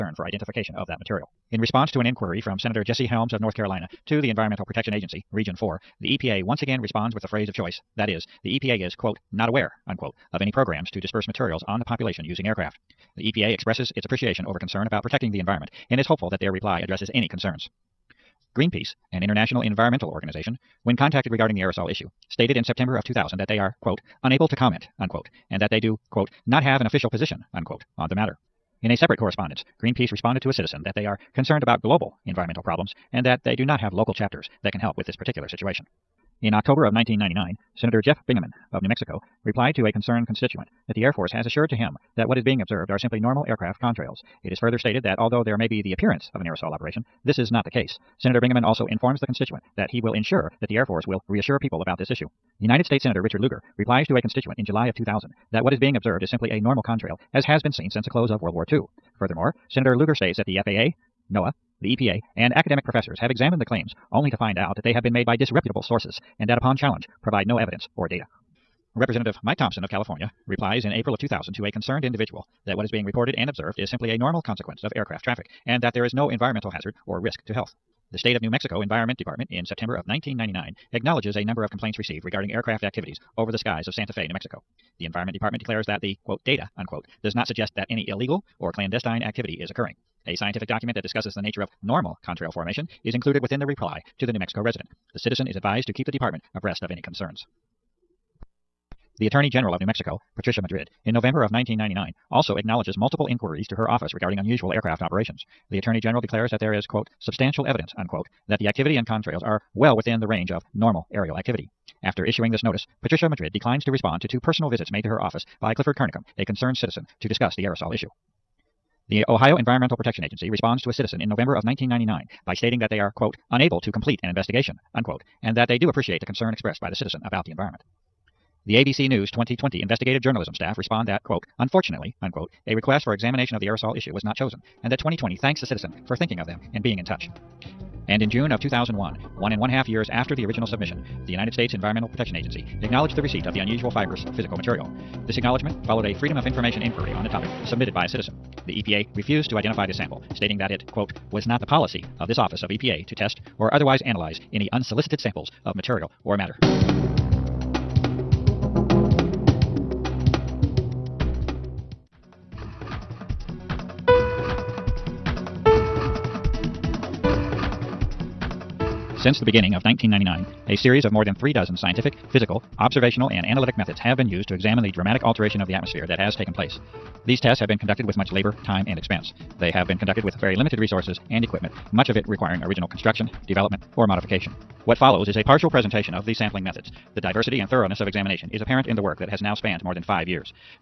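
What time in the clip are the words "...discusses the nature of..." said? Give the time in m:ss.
1:31.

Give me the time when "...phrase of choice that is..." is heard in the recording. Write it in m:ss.
0:07.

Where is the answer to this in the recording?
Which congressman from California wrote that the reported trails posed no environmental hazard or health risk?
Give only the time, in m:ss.
1:09.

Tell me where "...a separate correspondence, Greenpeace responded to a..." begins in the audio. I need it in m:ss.
0:28.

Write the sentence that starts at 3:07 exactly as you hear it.
The diversity and thoroughness of examination is apparent in the work that has now spanned more than five years.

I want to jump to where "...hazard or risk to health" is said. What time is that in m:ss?
1:16.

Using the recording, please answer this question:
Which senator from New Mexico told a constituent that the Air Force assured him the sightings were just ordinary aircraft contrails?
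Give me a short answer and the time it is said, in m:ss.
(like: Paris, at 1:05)
Jeff Bingaman, at 0:38.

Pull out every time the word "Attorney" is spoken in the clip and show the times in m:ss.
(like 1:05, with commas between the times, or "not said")
1:39, 1:45.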